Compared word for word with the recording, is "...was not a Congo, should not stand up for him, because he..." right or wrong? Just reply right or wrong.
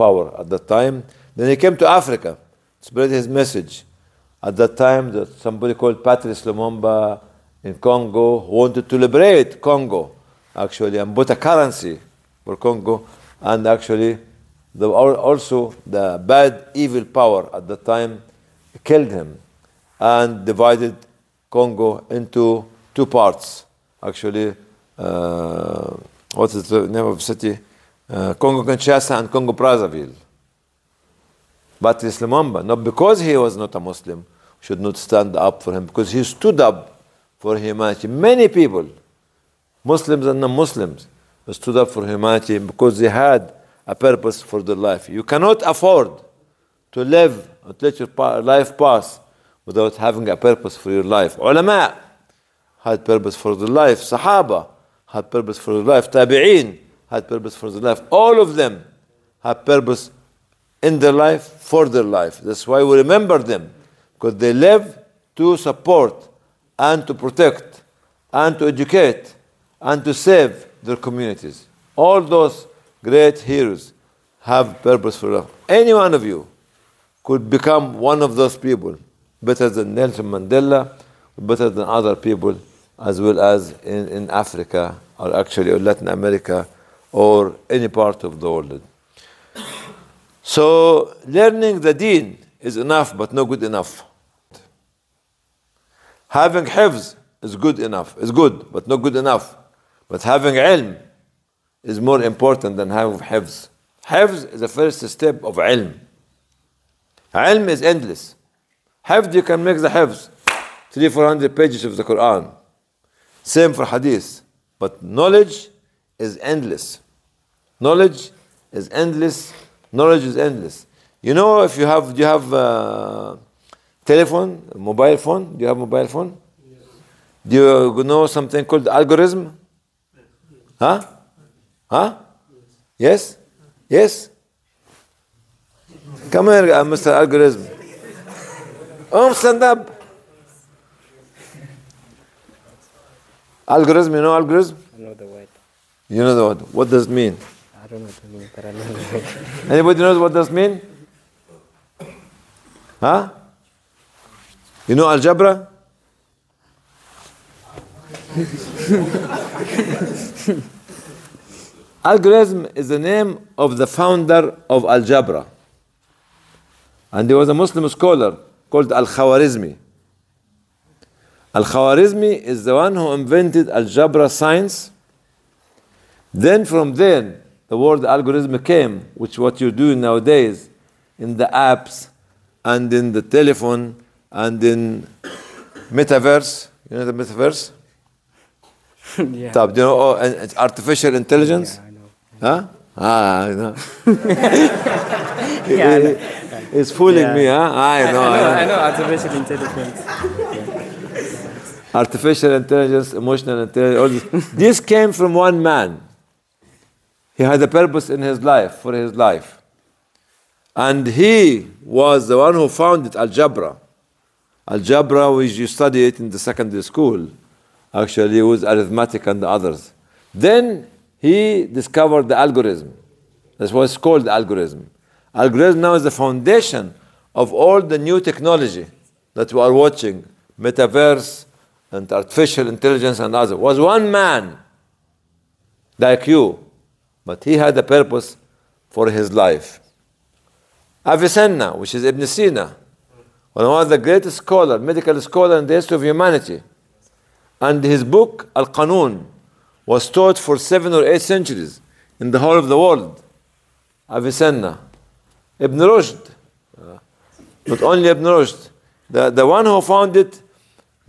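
wrong.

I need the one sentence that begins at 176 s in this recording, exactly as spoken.
Then, from then, the word algorithm came, which what you do nowadays in the apps and in the telephone and in metaverse.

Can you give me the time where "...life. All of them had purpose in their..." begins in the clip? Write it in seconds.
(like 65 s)
57 s.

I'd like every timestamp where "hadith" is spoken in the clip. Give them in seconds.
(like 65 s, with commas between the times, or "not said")
113 s.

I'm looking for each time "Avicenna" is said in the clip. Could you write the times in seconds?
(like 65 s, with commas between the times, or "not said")
241 s, 254 s.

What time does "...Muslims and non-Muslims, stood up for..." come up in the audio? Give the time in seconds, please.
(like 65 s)
39 s.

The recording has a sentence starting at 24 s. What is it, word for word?
Actually, uh, what is the name of the city?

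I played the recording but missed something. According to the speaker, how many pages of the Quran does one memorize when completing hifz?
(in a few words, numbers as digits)
300-400.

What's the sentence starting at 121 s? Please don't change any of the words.
You know, if you have, do you have a uh, telephone, a mobile phone?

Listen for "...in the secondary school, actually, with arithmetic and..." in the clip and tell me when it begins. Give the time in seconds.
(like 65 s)
216 s.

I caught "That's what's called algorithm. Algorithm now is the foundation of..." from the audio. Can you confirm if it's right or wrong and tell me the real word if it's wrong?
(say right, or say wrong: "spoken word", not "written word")
right.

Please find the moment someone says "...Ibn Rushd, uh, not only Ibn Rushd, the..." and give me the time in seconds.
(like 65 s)
255 s.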